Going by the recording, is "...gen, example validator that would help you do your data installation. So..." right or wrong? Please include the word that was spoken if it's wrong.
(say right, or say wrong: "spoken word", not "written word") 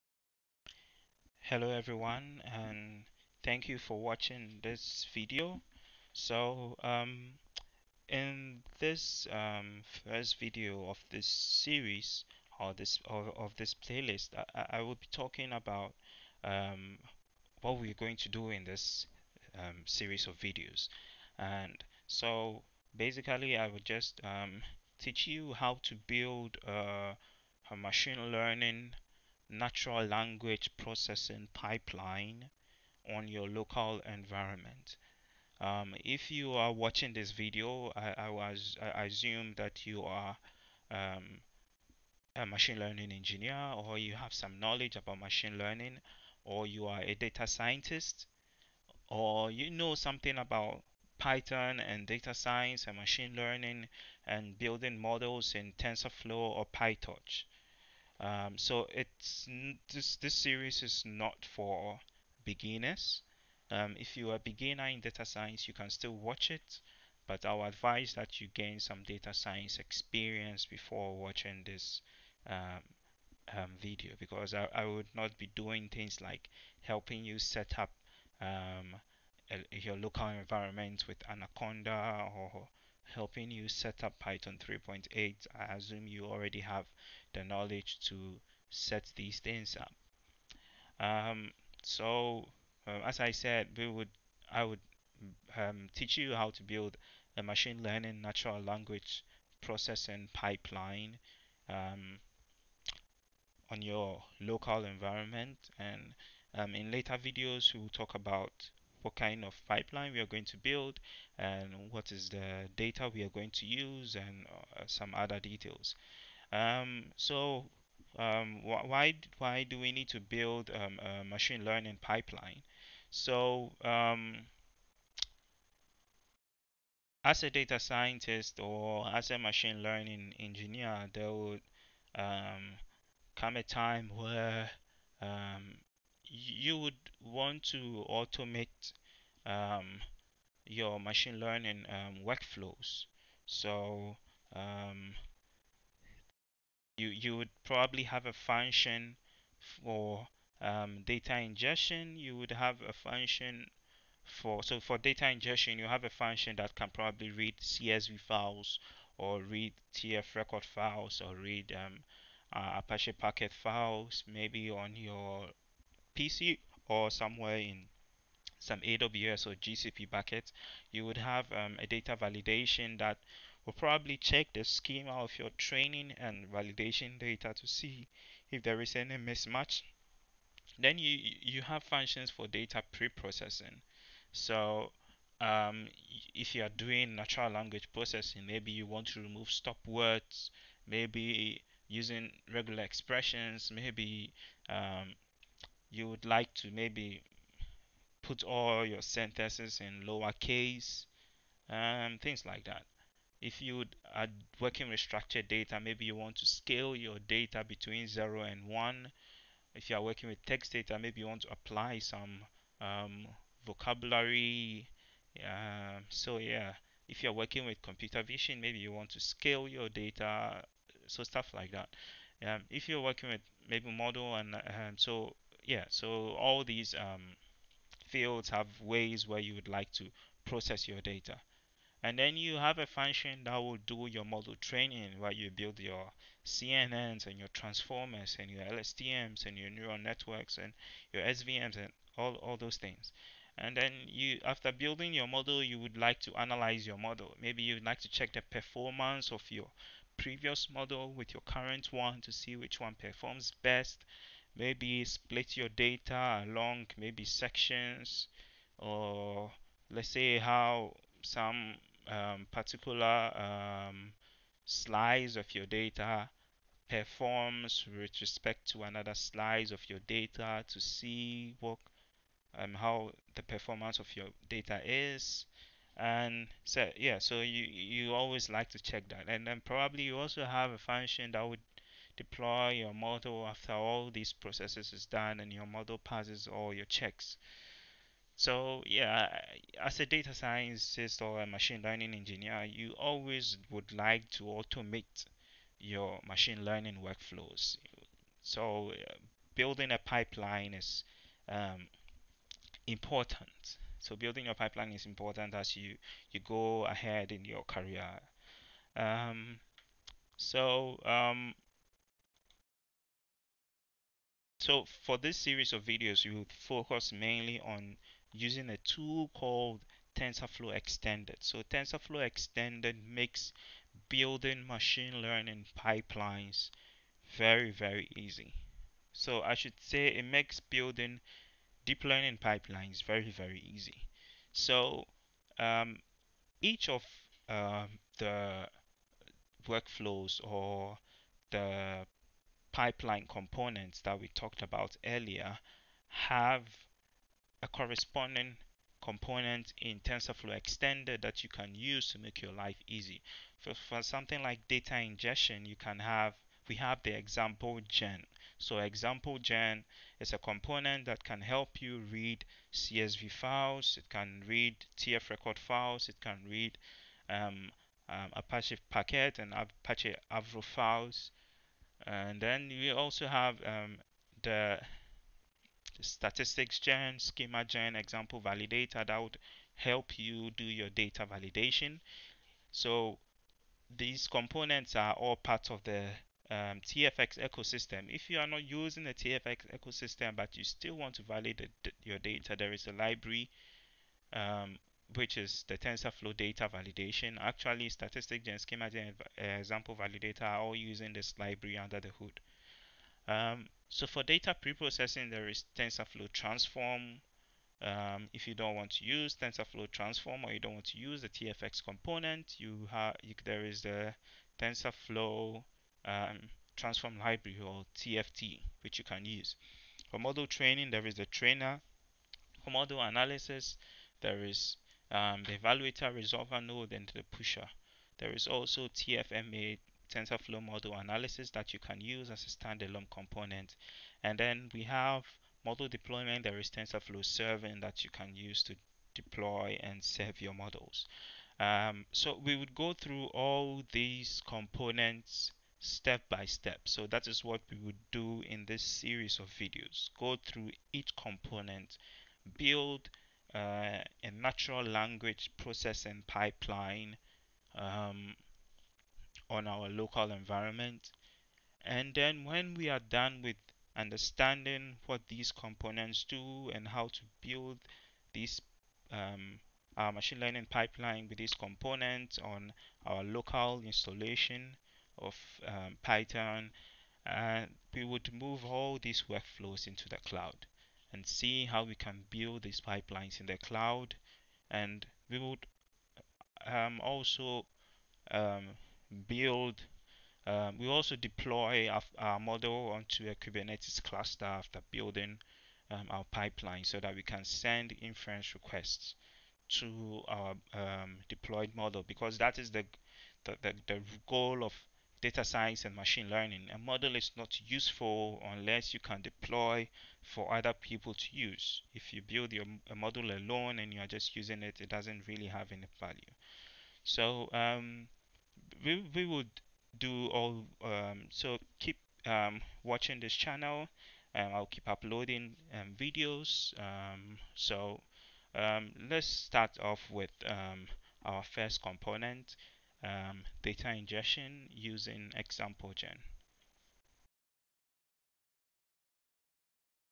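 wrong: "validation", not "installation".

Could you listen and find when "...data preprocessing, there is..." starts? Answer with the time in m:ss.
6:44.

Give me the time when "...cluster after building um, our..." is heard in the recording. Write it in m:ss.
8:14.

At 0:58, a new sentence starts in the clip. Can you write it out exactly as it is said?
Um, so it's this this series is not for beginners.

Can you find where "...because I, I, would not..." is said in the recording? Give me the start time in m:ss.
1:14.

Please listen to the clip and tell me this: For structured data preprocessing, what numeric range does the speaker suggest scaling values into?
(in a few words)
0 and 1.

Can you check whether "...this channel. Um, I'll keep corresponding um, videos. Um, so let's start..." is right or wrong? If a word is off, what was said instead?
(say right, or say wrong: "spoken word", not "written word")
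wrong: "uploading", not "corresponding".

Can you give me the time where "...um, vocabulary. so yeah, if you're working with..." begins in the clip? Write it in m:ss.
3:32.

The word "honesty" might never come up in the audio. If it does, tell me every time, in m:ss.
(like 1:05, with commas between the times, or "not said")
not said.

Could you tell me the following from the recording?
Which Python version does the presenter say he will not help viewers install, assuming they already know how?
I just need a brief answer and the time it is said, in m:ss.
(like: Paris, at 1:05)
Python 3.8, at 1:24.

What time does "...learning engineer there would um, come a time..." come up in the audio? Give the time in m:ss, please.
2:09.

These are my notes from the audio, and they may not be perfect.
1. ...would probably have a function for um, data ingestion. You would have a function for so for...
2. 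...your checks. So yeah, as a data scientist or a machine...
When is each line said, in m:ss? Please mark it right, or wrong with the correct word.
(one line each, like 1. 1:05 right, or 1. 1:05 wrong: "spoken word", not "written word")
1. 2:27 right
2. 4:46 right.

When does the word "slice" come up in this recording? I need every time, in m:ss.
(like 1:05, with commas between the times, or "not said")
4:24, 4:29.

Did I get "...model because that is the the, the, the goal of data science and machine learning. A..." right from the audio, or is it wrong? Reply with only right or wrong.
right.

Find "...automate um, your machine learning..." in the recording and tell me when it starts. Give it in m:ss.
2:18.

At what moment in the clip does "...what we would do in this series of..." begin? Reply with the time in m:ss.
7:27.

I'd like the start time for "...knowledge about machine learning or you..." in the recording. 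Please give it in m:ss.
0:44.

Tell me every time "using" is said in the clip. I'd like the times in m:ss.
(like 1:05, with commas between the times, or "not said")
3:11, 5:18, 6:28, 6:40, 8:34, 8:54.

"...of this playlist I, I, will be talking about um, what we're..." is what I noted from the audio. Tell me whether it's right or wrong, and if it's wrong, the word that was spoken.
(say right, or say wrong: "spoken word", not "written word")
right.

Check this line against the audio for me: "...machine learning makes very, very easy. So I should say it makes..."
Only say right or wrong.
wrong.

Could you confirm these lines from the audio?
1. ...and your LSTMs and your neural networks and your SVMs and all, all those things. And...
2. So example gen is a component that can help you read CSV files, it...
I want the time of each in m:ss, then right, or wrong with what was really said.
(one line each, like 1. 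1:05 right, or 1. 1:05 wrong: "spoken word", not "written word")
1. 3:58 right
2. 5:58 right.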